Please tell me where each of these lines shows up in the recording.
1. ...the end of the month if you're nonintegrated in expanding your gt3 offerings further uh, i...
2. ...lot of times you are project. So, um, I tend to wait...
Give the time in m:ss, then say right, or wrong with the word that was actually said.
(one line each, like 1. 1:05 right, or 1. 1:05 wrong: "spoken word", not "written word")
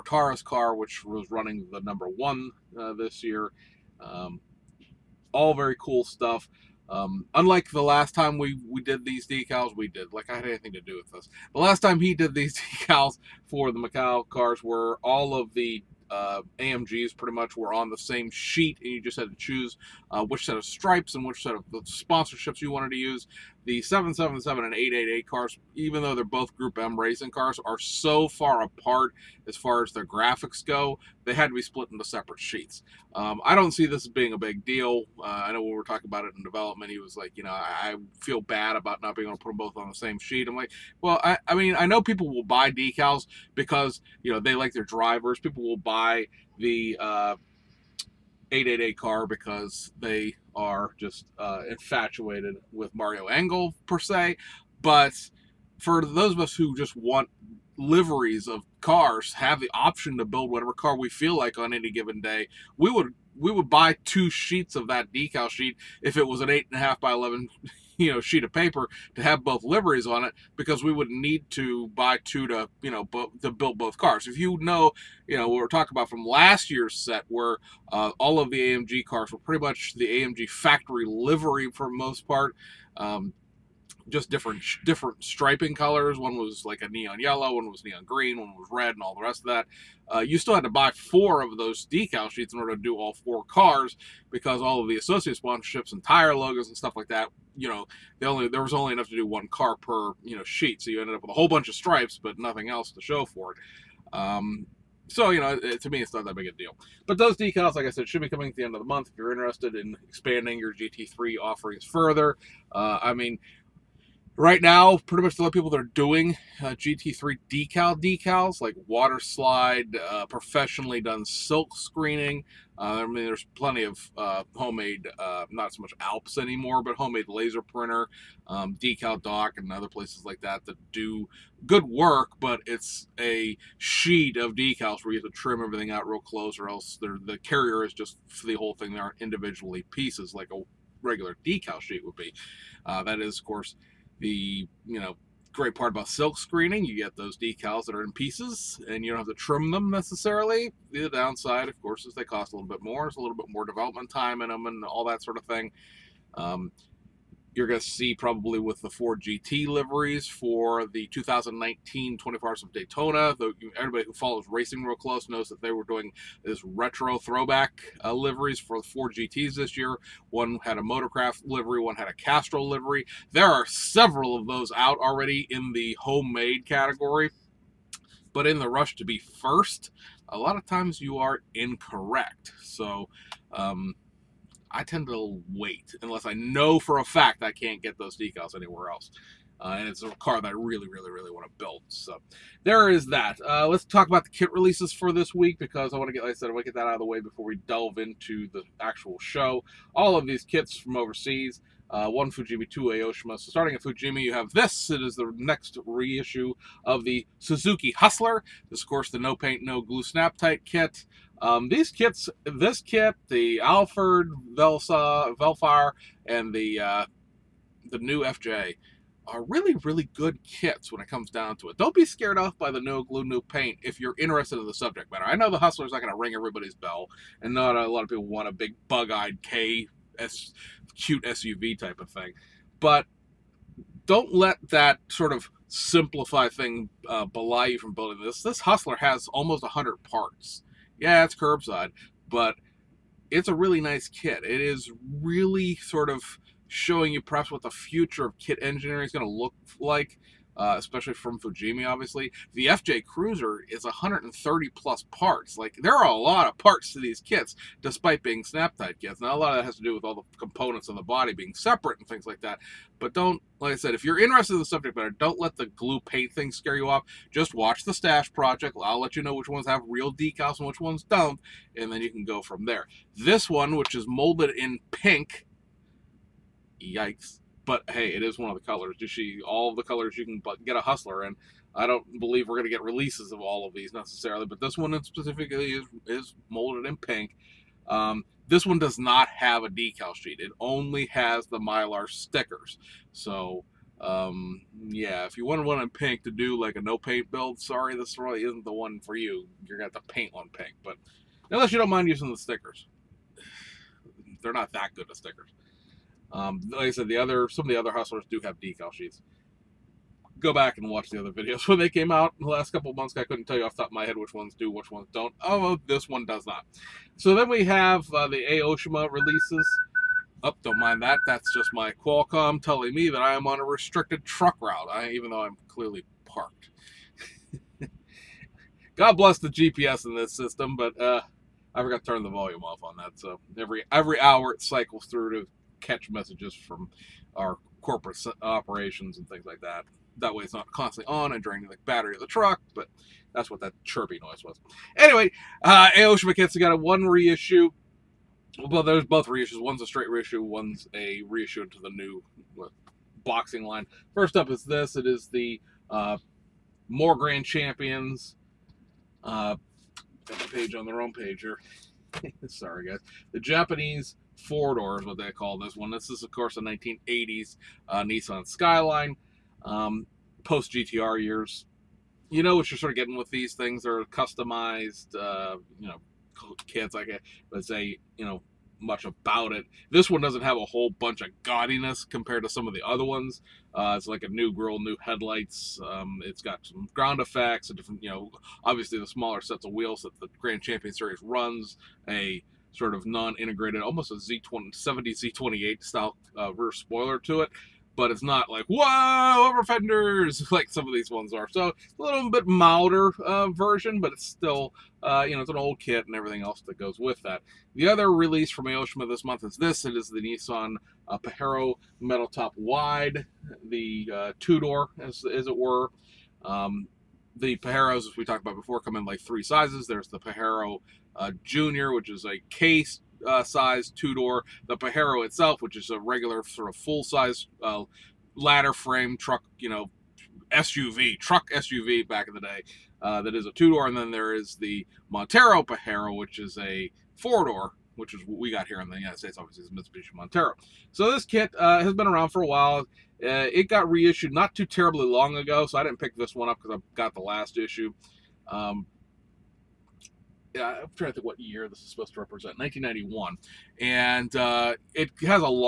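1. 1:48 wrong: "interested", not "nonintegrated"
2. 3:00 wrong: "incorrect", not "project".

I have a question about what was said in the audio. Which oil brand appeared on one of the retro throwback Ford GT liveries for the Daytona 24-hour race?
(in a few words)
Castrol.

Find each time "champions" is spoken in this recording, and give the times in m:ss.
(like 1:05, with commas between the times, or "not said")
5:57, 6:30.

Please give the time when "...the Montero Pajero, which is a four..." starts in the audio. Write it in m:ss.
7:14.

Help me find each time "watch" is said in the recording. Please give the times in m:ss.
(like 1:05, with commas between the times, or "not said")
4:27, 5:10.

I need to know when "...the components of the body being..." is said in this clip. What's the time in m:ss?
4:20.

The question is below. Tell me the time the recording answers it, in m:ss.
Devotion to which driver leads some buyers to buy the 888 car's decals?
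0:52.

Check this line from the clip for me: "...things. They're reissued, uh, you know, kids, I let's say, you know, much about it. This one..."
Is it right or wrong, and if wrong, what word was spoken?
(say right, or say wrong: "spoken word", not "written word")
wrong: "customized", not "reissued".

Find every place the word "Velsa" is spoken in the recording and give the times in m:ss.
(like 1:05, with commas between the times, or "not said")
3:34.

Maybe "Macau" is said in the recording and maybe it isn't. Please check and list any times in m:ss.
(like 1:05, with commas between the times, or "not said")
0:13.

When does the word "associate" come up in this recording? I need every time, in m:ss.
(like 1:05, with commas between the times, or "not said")
1:34.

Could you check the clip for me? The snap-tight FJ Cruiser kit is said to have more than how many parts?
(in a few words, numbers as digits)
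130.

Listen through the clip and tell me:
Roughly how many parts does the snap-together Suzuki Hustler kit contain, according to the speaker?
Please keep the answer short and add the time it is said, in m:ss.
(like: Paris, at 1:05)
almost 100, at 3:59.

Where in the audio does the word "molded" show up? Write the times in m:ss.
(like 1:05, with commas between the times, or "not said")
4:34, 4:46.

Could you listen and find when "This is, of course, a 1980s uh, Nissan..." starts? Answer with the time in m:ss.
6:05.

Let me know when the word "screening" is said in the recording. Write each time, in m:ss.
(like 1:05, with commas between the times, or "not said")
2:01, 2:26.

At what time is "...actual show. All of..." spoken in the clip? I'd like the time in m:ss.
3:18.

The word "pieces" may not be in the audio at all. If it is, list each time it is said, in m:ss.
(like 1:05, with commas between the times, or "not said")
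2:19, 2:28.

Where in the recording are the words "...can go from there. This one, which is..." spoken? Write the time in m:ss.
4:32.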